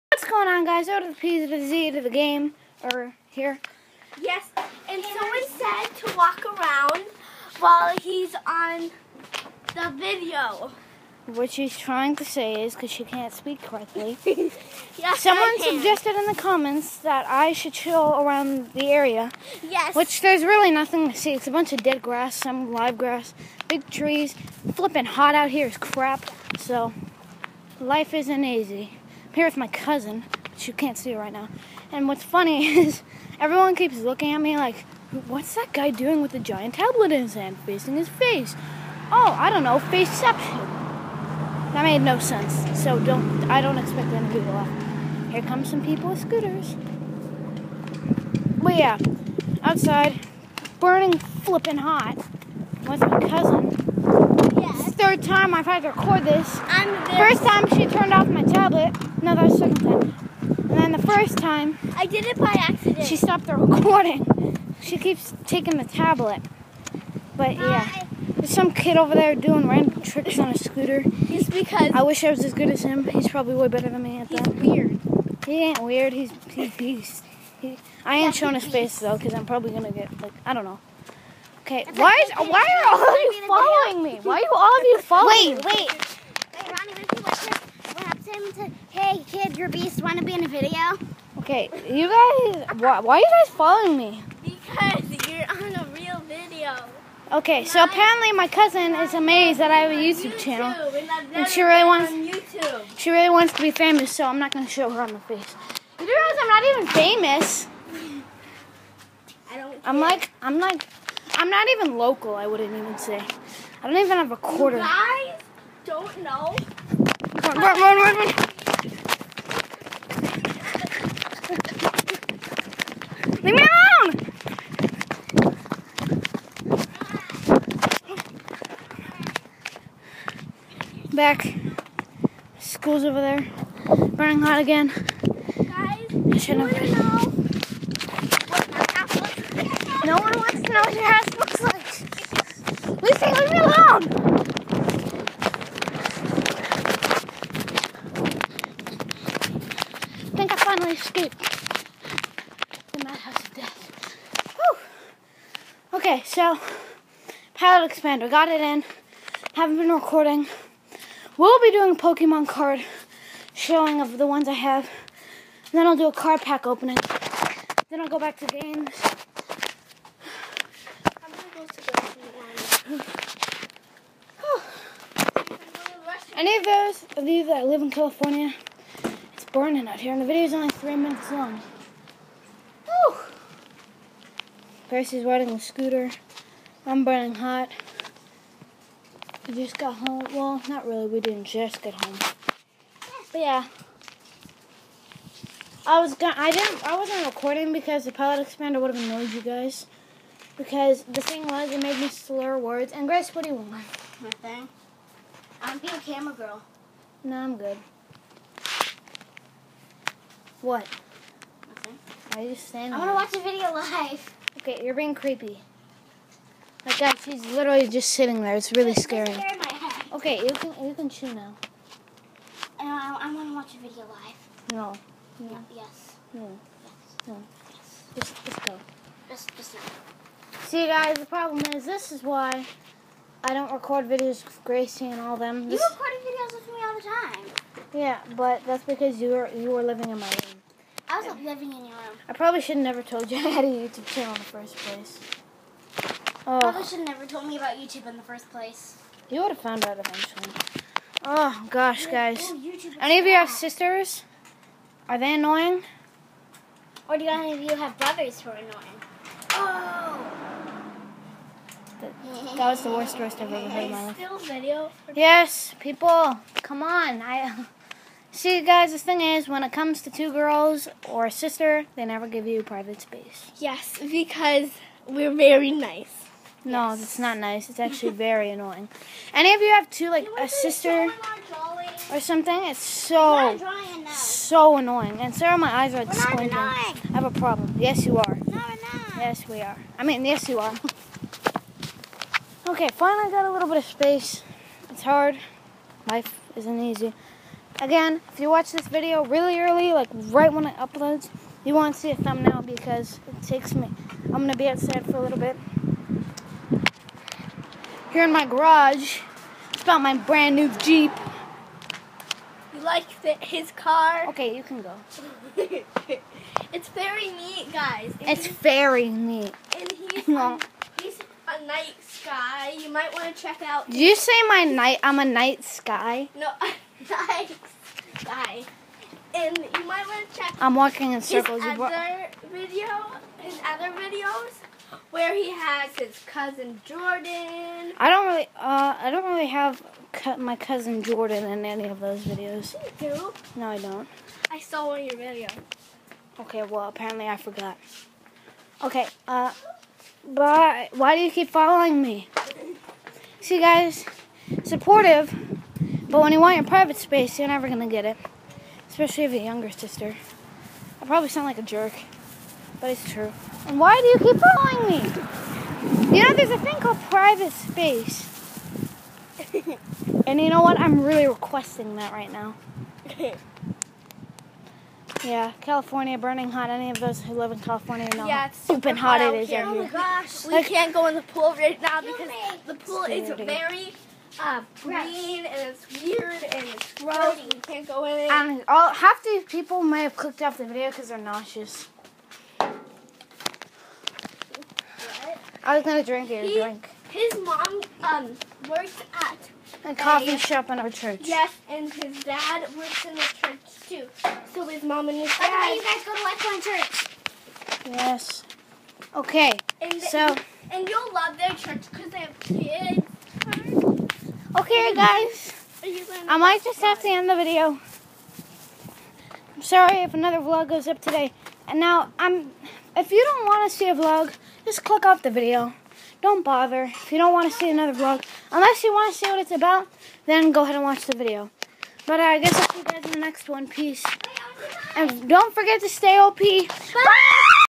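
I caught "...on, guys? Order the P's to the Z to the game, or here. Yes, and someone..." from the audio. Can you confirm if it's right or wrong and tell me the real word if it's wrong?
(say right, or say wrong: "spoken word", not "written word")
right.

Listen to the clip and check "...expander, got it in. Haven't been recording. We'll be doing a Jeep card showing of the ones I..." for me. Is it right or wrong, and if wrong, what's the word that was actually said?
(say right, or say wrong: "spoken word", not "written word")
wrong: "Pokemon", not "Jeep".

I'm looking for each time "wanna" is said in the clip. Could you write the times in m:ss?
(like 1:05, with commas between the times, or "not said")
1:30.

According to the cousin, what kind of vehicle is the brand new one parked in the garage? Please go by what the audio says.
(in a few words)
Jeep.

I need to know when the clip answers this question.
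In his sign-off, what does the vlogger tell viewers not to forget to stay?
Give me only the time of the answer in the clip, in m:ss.
7:16.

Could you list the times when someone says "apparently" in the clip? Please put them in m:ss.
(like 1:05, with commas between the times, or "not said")
1:37, 5:46.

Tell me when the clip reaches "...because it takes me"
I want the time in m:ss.
5:02.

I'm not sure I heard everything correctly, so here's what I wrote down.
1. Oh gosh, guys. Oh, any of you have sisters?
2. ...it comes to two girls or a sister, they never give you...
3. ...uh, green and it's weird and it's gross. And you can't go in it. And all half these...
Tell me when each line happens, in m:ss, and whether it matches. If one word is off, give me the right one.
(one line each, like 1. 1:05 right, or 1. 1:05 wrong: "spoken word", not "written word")
1. 4:11 right
2. 4:29 right
3. 6:24 right.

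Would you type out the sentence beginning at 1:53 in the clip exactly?
I don't even have a quarter.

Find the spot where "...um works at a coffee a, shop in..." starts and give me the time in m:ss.
6:38.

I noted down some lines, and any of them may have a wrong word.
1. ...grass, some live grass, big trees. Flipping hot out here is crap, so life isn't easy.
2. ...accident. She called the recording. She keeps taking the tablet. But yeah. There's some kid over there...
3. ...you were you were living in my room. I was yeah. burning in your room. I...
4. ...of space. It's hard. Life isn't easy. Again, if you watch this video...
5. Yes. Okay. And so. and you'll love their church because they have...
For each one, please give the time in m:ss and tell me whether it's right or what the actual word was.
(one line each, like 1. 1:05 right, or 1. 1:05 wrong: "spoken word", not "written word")
1. 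0:22 right
2. 1:02 wrong: "stopped", not "called"
3. 3:59 wrong: "living", not "burning"
4. 4:53 right
5. 6:47 right.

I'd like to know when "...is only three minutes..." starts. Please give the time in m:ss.
3:00.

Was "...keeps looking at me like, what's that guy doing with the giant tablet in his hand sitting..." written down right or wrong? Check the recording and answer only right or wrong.
wrong.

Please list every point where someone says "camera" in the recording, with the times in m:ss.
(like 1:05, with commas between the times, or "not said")
3:26.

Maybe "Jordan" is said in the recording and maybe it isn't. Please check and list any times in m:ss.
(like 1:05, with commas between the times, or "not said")
5:36, 5:41.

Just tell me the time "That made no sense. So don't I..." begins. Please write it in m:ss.
0:41.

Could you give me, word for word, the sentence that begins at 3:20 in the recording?
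Because the thing was, it made me slur words.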